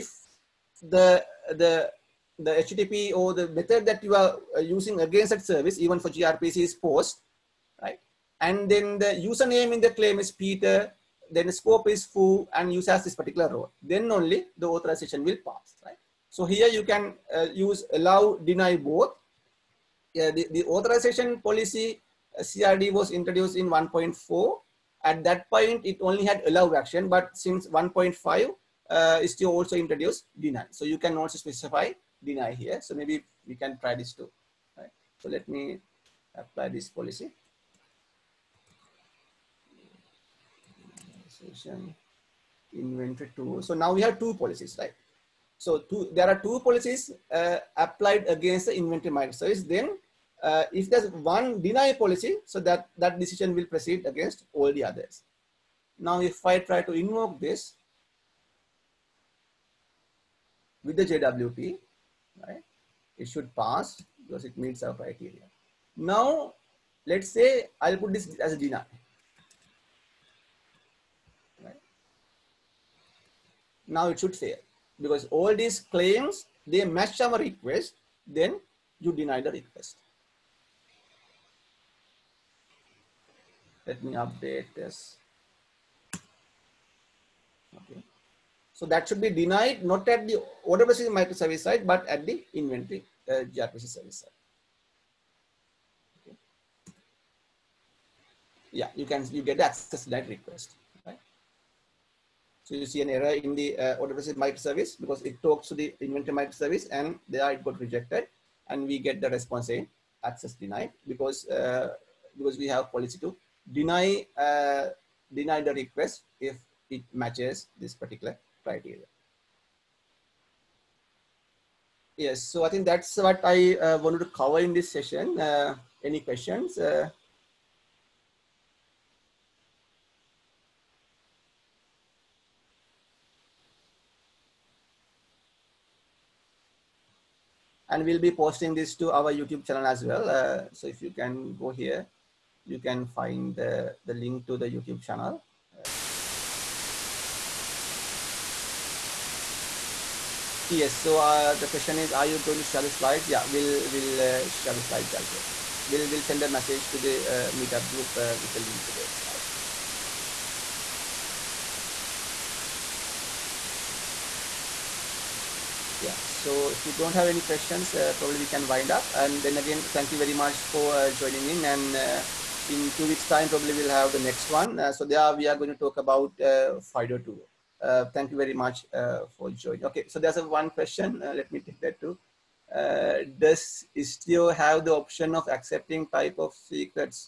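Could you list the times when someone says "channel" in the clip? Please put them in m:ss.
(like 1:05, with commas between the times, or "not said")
2:19, 2:25.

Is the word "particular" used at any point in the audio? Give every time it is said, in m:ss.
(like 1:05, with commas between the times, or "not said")
0:13, 1:57.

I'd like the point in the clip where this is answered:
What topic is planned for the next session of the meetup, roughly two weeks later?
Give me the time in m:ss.
2:56.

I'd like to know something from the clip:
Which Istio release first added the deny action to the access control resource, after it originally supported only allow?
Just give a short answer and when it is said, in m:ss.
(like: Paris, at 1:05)
1.5, at 0:27.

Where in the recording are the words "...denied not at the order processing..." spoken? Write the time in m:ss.
1:29.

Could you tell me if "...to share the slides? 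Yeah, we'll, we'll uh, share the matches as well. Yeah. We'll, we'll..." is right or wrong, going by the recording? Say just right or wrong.
wrong.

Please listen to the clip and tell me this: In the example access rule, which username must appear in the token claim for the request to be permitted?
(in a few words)
Peter.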